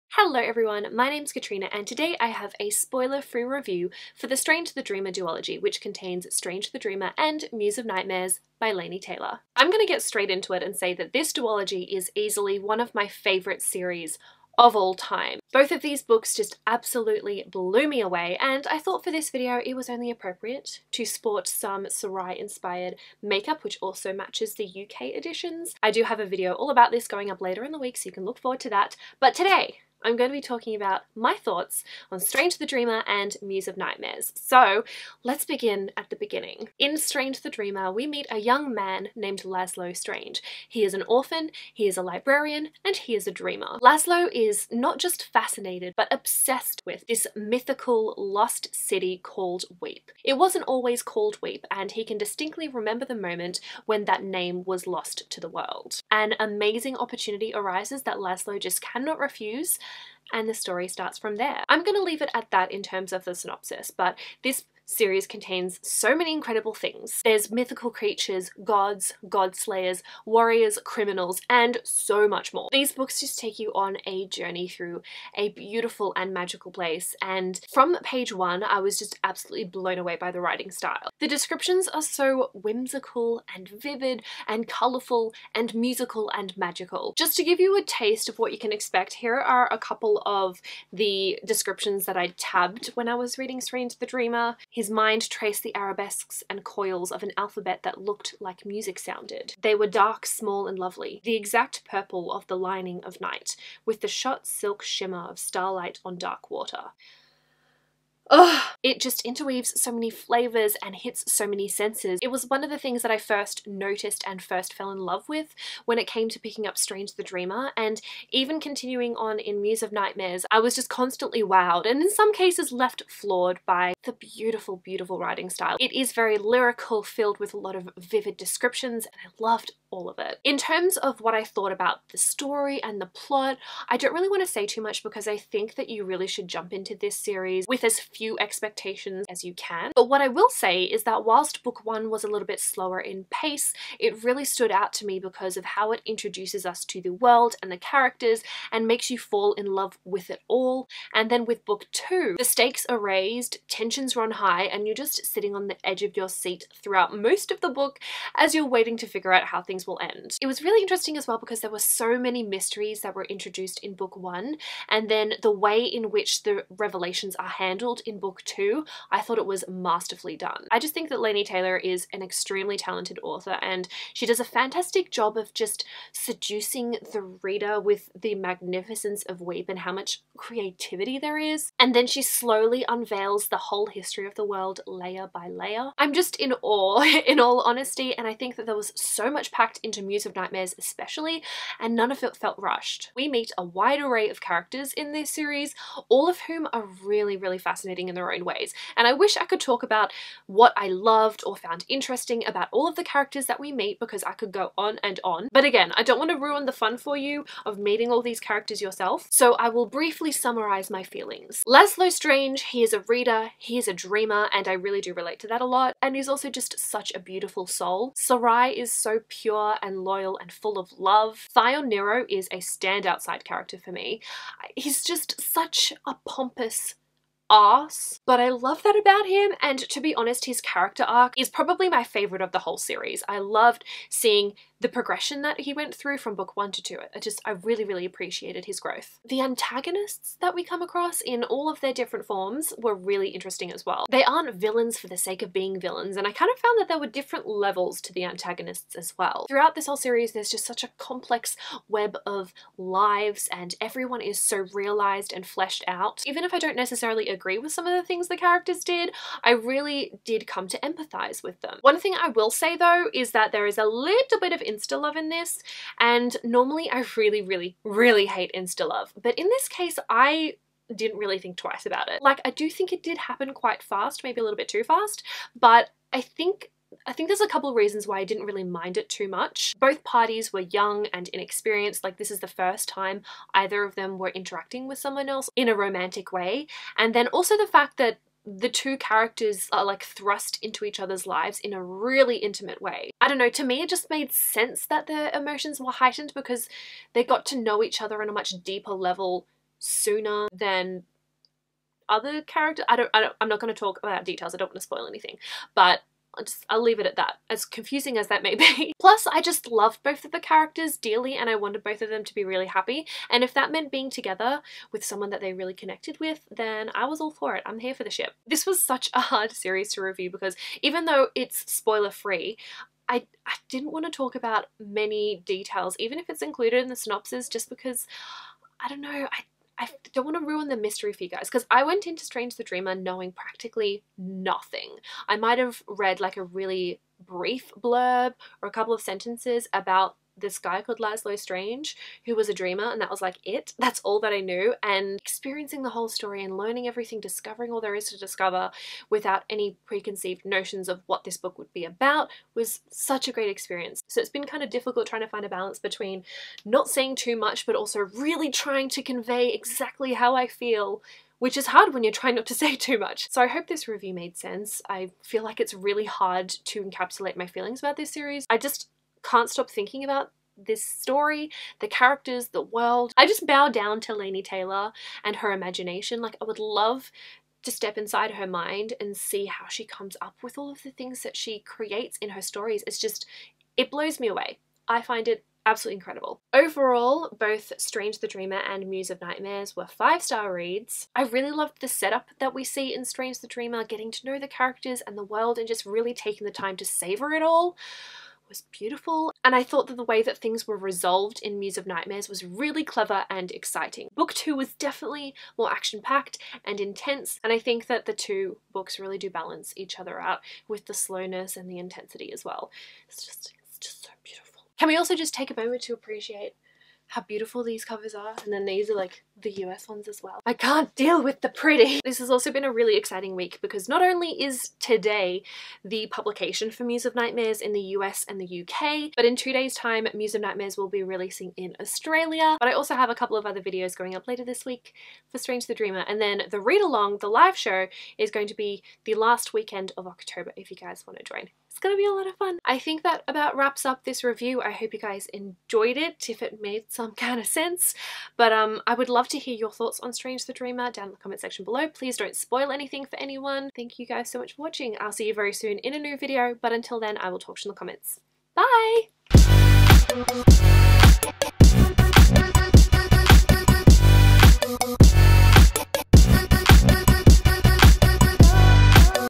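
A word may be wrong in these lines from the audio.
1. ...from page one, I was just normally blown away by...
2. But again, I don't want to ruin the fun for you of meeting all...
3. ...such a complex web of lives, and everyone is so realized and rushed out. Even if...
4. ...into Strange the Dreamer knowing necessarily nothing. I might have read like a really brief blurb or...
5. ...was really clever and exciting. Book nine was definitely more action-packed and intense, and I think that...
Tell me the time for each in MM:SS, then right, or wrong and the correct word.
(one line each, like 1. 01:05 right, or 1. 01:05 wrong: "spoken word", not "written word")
1. 01:17 wrong: "absolutely", not "normally"
2. 03:25 right
3. 04:10 wrong: "fleshed", not "rushed"
4. 05:32 wrong: "practically", not "necessarily"
5. 06:42 wrong: "two", not "nine".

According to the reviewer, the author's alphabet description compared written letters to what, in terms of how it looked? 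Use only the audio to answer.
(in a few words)
like music sounded.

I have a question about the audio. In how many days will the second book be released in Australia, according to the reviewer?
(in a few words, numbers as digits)
2 days.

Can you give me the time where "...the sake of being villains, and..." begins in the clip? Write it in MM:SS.
04:05.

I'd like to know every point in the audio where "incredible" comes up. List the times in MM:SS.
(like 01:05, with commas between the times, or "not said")
01:06, 06:25.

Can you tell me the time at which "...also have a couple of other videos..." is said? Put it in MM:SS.
07:12.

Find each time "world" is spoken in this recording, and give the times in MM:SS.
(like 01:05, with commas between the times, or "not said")
00:55, 02:27, 03:04, 06:12, 06:35.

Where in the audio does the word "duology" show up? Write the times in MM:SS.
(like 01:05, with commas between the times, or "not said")
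00:05, 00:11.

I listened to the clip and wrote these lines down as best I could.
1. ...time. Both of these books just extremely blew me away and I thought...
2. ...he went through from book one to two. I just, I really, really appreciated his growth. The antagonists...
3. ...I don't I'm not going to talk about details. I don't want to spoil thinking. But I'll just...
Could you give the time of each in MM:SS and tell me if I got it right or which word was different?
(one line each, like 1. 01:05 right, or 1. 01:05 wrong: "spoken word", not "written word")
1. 00:14 wrong: "absolutely", not "extremely"
2. 03:55 right
3. 05:03 wrong: "anything", not "thinking".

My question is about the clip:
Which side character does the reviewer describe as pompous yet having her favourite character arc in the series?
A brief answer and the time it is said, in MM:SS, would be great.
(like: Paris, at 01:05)
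Thyon Nero, at 03:41.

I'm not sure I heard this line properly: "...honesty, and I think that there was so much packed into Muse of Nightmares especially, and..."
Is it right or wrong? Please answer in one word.
right.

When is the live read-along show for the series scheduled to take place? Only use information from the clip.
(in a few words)
last weekend of October.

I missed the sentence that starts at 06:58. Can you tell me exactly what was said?
And then these are like the US ones as well.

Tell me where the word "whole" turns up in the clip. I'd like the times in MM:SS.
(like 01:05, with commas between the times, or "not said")
03:03, 03:52, 04:09, 05:45.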